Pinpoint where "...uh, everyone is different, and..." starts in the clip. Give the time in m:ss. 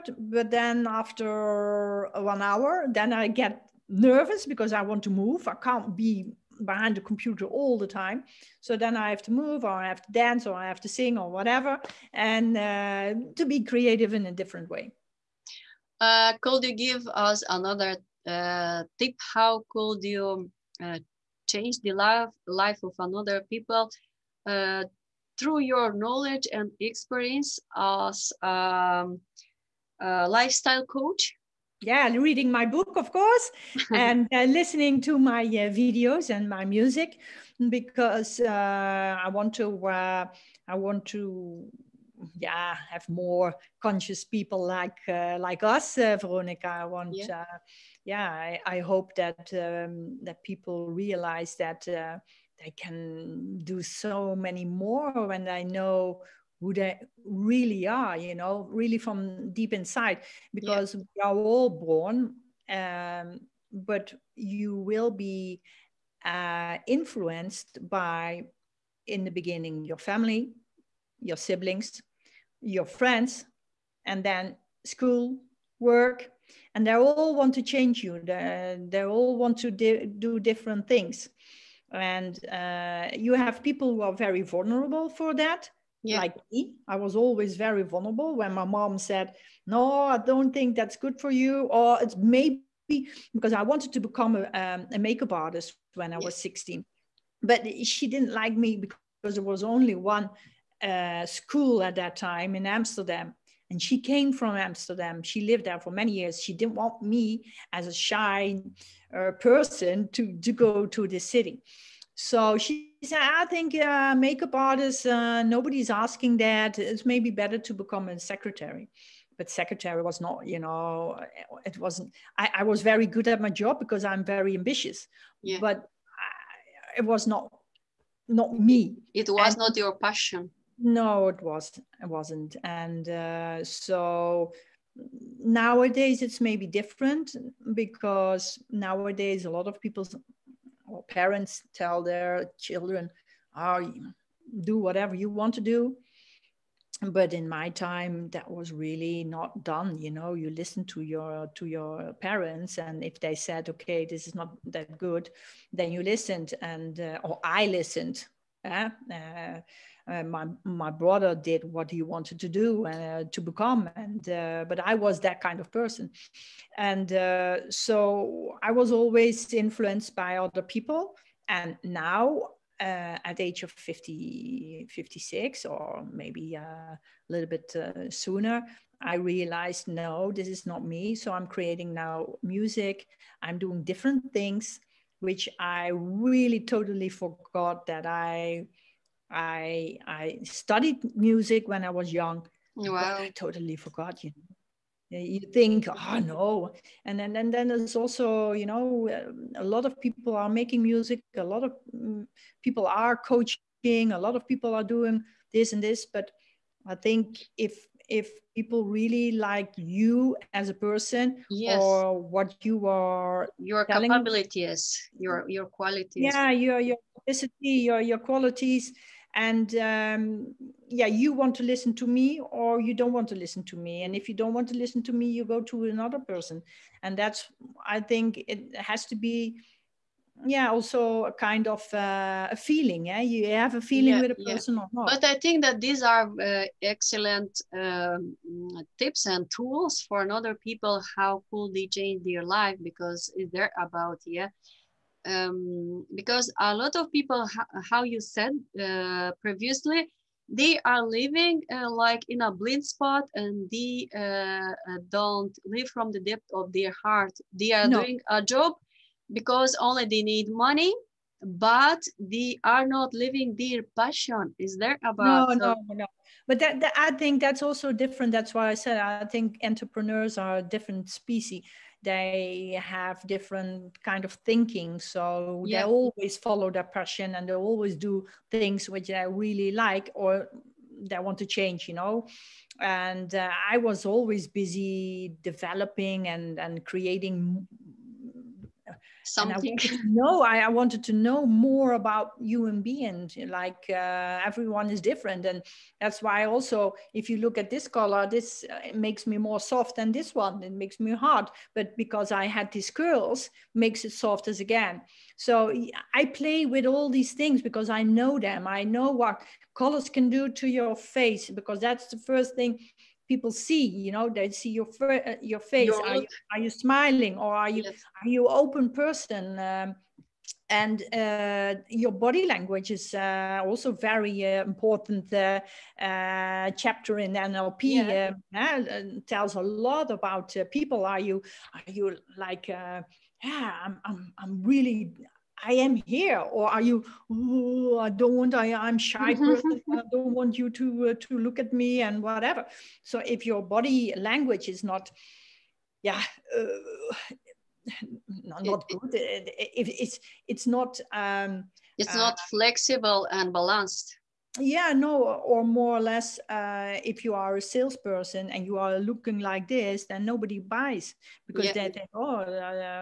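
4:53.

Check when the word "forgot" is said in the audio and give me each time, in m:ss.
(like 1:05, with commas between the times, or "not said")
3:07, 3:13.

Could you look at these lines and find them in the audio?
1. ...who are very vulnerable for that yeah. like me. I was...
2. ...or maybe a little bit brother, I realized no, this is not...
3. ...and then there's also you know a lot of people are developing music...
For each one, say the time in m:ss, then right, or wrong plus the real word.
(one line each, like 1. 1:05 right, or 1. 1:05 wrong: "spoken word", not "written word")
1. 1:23 right
2. 2:55 wrong: "sooner", not "brother"
3. 3:17 wrong: "making", not "developing".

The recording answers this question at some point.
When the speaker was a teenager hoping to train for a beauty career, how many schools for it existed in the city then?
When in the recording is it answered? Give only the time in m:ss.
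1:39.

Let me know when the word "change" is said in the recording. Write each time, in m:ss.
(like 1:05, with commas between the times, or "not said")
0:21, 1:17, 4:01, 4:41.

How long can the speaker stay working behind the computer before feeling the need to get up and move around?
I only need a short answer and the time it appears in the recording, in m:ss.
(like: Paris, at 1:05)
1 hour, at 0:02.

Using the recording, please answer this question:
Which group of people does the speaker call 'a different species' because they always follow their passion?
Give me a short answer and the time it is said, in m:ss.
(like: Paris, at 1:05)
entrepreneurs, at 4:29.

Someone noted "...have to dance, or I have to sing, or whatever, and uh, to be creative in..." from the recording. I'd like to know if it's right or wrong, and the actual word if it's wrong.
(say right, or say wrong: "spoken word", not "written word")
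right.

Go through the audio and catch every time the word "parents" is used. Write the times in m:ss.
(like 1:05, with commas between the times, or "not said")
2:21, 2:32.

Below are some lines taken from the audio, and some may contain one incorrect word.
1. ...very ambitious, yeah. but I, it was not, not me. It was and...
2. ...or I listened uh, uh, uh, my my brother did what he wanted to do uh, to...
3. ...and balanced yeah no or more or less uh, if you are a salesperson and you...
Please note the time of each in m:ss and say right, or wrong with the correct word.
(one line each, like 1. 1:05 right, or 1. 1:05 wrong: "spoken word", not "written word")
1. 2:04 right
2. 2:37 right
3. 5:53 right.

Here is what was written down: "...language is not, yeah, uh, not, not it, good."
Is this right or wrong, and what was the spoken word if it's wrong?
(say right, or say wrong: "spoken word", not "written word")
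right.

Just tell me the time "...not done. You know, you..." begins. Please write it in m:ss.
2:29.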